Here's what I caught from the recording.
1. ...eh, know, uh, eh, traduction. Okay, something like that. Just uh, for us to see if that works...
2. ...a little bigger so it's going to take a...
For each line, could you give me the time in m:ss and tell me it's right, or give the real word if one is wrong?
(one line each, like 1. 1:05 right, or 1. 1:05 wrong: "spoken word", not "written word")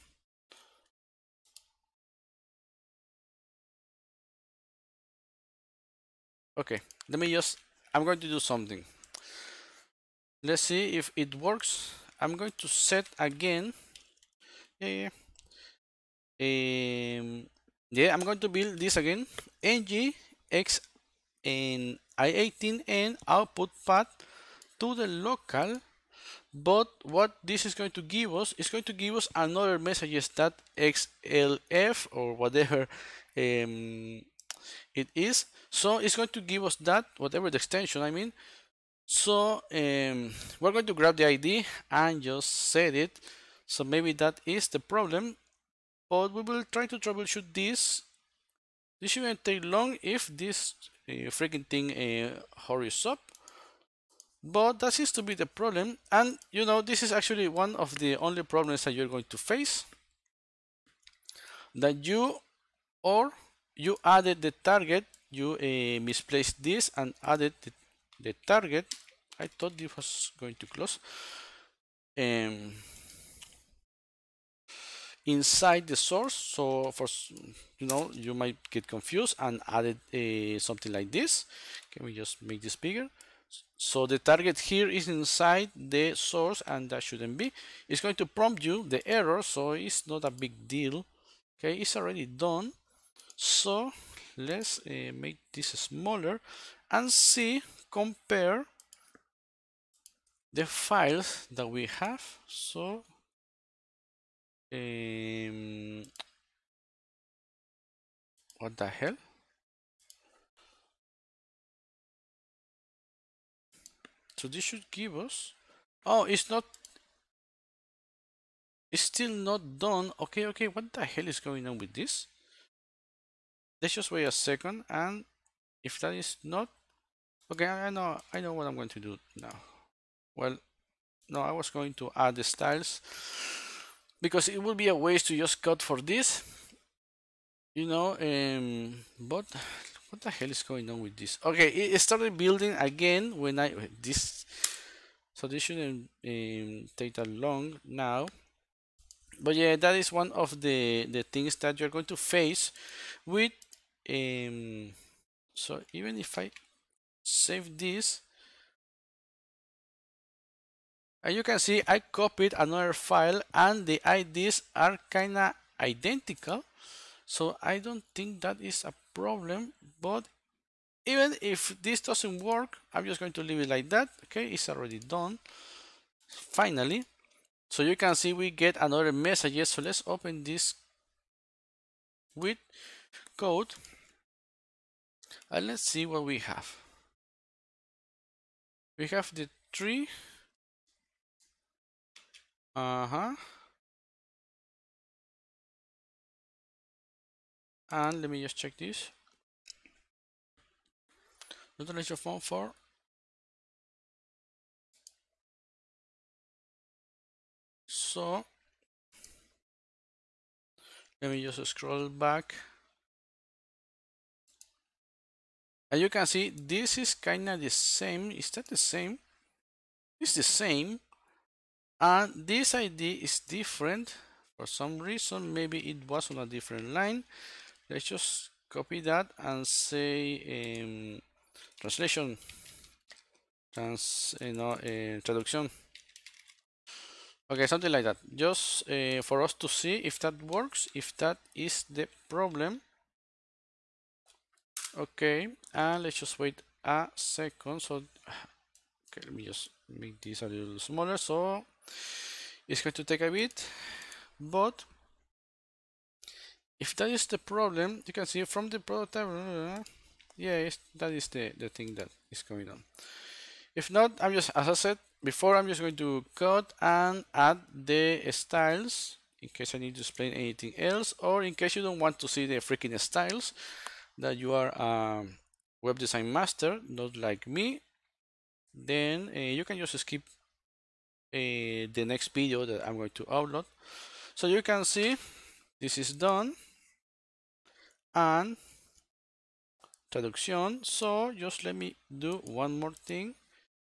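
1. 3:54 right
2. 4:10 wrong: "smaller", not "bigger".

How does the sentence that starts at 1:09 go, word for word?
I thought this was going to close.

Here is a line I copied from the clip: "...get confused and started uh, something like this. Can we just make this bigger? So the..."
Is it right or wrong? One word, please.
wrong.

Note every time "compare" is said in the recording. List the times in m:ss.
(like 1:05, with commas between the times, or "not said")
1:37.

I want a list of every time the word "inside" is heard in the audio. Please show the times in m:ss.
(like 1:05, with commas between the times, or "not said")
1:15, 1:25.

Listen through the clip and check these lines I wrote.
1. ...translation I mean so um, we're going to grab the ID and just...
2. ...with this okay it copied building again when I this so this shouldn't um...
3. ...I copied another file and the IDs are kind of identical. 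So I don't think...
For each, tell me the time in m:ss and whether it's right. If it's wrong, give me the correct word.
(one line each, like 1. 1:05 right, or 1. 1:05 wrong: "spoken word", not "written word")
1. 0:37 wrong: "extension", not "translation"
2. 2:21 wrong: "started", not "copied"
3. 2:41 right.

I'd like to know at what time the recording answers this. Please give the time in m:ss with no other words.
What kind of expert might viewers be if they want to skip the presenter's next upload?
4:35.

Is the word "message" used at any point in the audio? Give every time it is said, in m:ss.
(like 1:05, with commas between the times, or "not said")
0:29, 2:59.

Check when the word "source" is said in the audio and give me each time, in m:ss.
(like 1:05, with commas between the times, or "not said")
1:15, 1:26.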